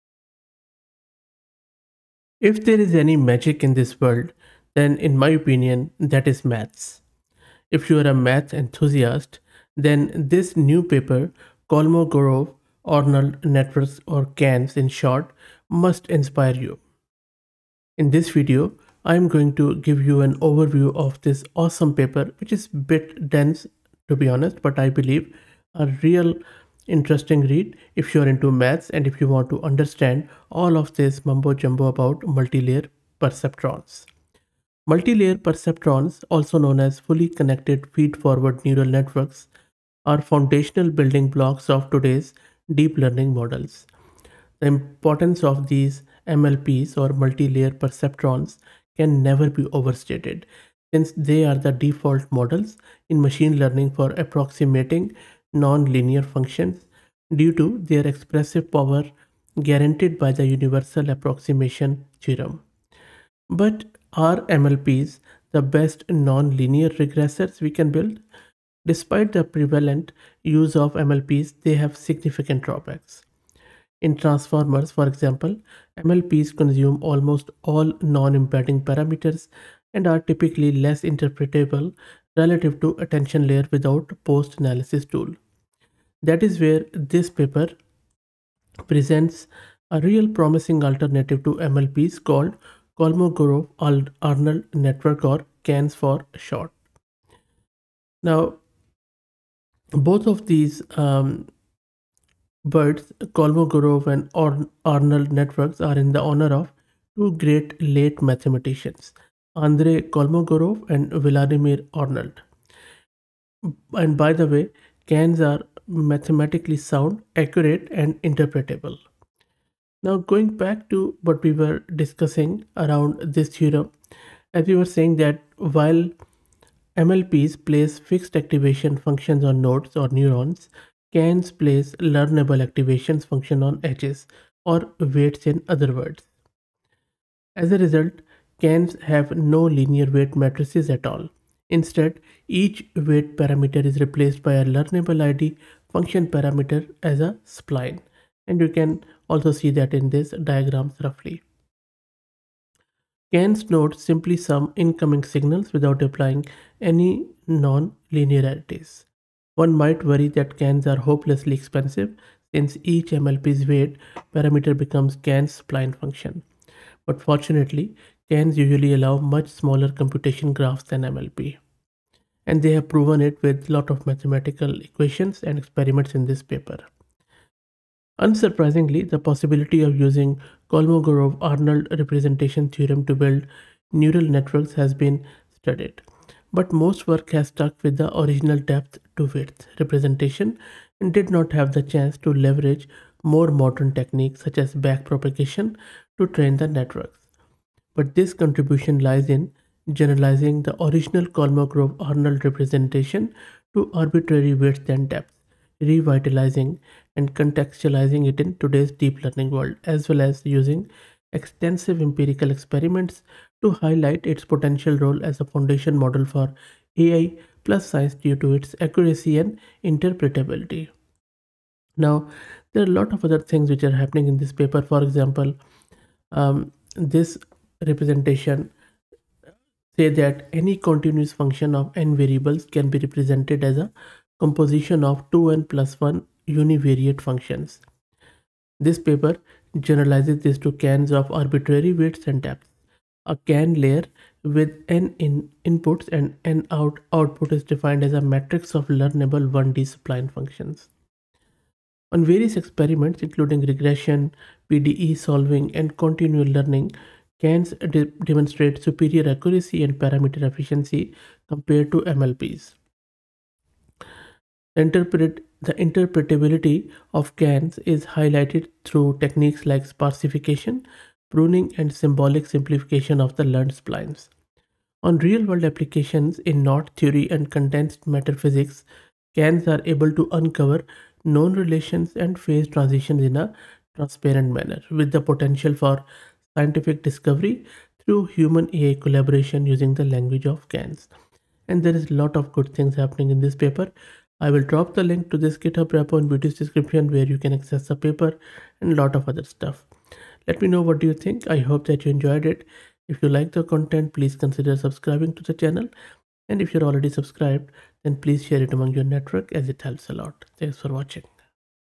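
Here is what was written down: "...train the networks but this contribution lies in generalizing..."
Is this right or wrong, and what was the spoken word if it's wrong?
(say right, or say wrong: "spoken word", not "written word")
right.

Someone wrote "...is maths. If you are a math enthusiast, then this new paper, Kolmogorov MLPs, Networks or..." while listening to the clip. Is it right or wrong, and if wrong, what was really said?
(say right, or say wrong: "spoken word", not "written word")
wrong: "Arnold", not "MLPs".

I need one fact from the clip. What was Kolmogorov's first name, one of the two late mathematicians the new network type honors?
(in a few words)
Andrei.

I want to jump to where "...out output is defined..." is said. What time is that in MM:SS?
04:06.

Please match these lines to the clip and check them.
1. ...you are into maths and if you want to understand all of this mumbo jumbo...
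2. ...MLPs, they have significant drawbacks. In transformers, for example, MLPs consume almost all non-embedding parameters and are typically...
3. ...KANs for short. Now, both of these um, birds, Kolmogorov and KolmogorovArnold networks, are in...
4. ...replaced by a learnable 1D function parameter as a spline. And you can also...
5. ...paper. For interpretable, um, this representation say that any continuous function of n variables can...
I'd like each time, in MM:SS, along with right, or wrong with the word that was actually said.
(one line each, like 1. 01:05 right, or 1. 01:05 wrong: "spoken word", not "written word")
1. 00:28 right
2. 01:10 right
3. 01:35 wrong: "Arnold", not "KolmogorovArnold"
4. 02:23 right
5. 03:44 wrong: "example", not "interpretable".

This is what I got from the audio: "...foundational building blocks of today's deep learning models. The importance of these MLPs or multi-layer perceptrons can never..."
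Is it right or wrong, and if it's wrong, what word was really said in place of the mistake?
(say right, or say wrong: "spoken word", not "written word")
right.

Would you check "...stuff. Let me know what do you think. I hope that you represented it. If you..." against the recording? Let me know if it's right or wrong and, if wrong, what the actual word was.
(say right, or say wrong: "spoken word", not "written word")
wrong: "enjoyed", not "represented".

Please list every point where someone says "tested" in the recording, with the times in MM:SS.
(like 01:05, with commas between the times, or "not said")
not said.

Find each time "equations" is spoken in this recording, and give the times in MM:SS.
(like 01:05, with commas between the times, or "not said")
02:54.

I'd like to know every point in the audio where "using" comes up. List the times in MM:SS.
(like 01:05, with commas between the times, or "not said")
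02:59, 03:30, 04:49.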